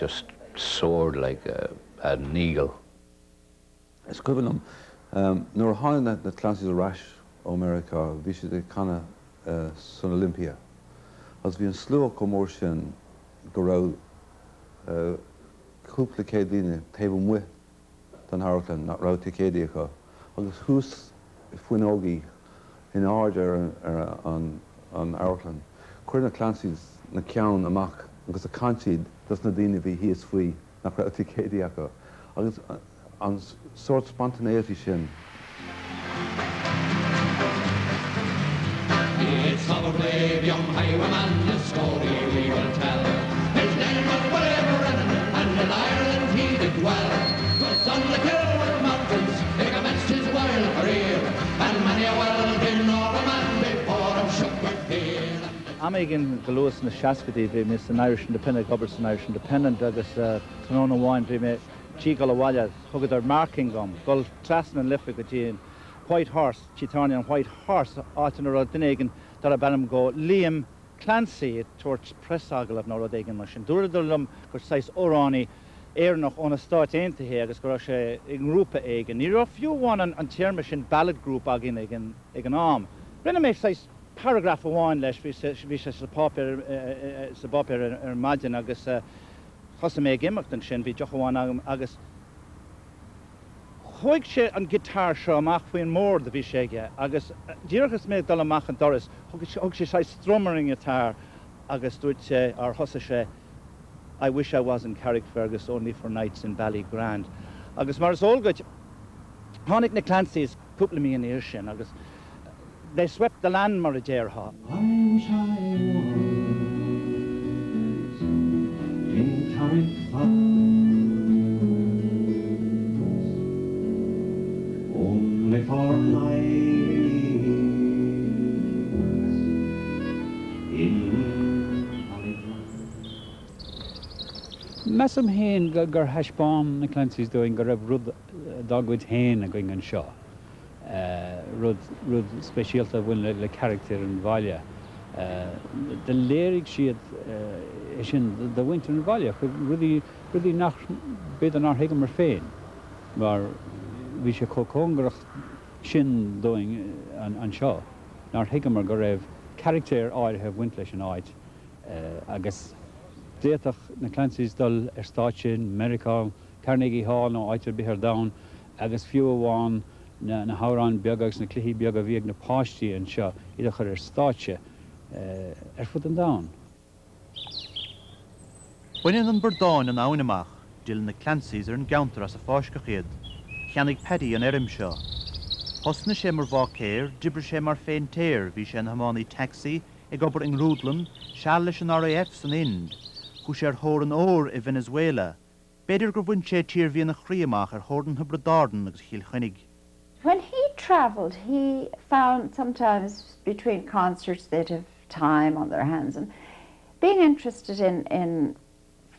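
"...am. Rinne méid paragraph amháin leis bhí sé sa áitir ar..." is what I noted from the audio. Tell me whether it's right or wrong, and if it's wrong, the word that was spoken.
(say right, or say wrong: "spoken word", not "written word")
wrong: "bopir", not "áitir".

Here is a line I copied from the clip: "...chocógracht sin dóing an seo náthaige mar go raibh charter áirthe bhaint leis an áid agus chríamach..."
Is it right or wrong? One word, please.
wrong.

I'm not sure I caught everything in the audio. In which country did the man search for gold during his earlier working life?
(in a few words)
Venezuela.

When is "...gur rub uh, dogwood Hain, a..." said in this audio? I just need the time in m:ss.
2:17.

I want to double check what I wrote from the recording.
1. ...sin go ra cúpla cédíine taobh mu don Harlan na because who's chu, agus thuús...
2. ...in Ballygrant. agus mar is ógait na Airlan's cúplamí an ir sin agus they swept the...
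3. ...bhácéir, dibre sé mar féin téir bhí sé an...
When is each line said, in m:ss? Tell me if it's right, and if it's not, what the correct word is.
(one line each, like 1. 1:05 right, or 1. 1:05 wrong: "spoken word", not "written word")
1. 0:12 right
2. 1:46 wrong: "Clancy", not "Airlan"
3. 3:06 right.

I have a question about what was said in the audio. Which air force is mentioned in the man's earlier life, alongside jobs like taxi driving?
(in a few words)
RAF.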